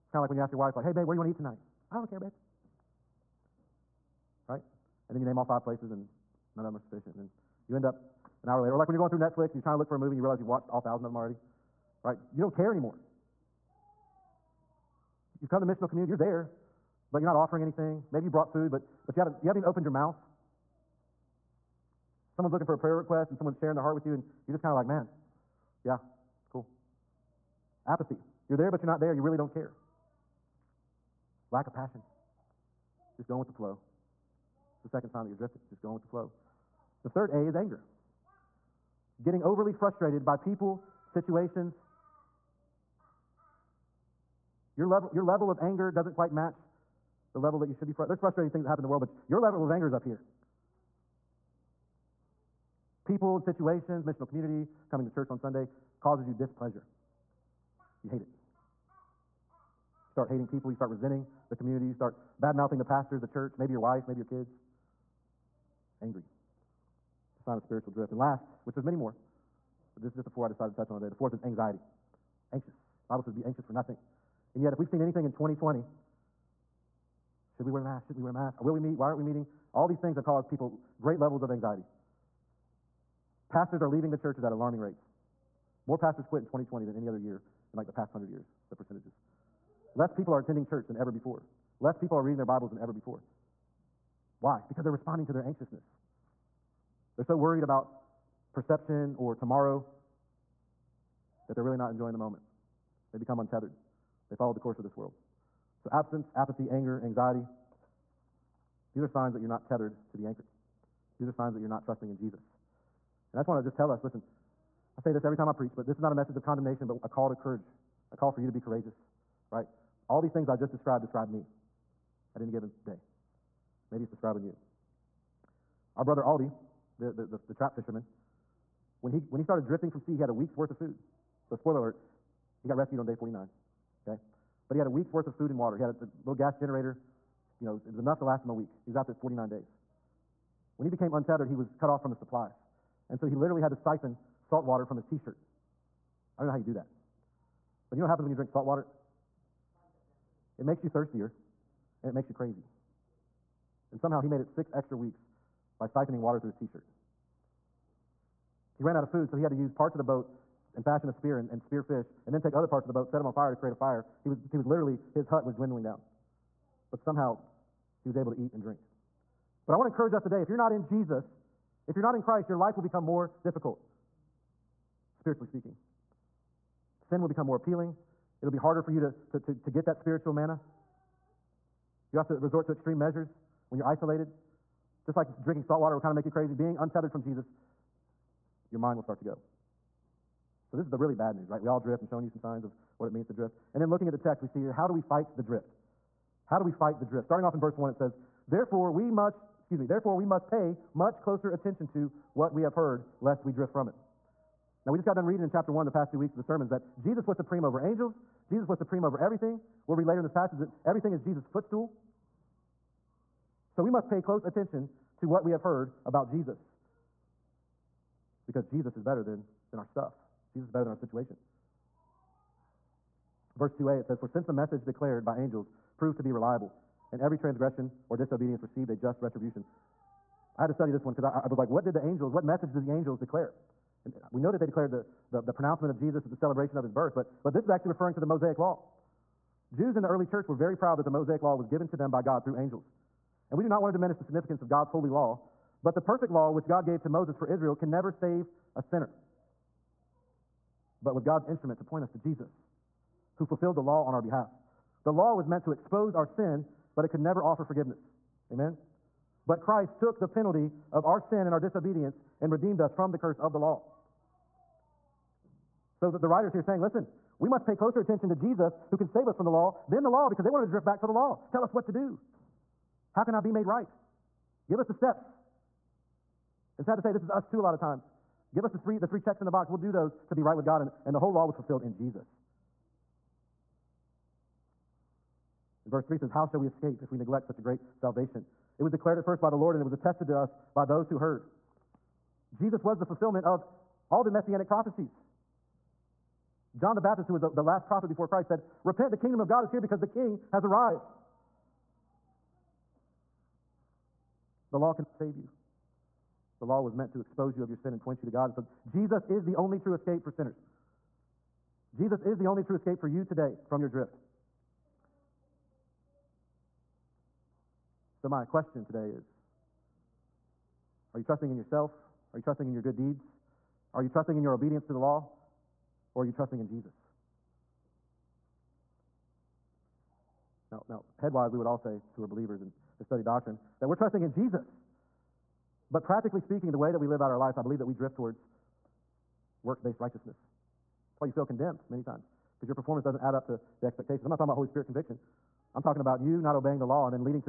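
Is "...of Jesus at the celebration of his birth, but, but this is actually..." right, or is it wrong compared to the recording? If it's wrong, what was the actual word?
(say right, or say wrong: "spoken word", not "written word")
right.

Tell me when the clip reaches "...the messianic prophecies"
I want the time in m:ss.
4:54.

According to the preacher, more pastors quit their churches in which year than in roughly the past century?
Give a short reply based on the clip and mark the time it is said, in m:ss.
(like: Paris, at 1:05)
2020, at 1:25.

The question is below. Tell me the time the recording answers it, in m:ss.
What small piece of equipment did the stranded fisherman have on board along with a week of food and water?
2:16.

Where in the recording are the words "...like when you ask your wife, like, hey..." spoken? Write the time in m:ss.
0:00.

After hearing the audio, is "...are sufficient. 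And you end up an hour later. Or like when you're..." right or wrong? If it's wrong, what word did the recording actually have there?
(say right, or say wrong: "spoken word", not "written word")
right.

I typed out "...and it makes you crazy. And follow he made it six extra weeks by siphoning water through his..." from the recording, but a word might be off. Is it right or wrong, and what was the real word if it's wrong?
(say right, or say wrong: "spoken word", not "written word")
wrong: "somehow", not "follow".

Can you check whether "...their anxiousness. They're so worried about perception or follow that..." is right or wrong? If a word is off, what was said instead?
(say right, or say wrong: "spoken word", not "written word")
wrong: "tomorrow", not "follow".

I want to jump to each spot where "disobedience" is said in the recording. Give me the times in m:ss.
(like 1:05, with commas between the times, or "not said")
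3:48, 4:21.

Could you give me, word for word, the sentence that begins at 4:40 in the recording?
And, and the whole law was fulfilled in Jesus.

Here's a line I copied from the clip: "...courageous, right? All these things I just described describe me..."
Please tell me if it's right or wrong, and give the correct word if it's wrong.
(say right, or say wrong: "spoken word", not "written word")
right.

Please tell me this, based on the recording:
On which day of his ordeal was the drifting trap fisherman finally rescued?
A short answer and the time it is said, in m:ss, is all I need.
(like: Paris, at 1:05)
Day 49, at 2:12.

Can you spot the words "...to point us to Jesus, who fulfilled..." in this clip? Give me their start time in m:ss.
4:11.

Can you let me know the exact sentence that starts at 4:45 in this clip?
In verse 3 says, How shall we escape if we neglect such a great salvation?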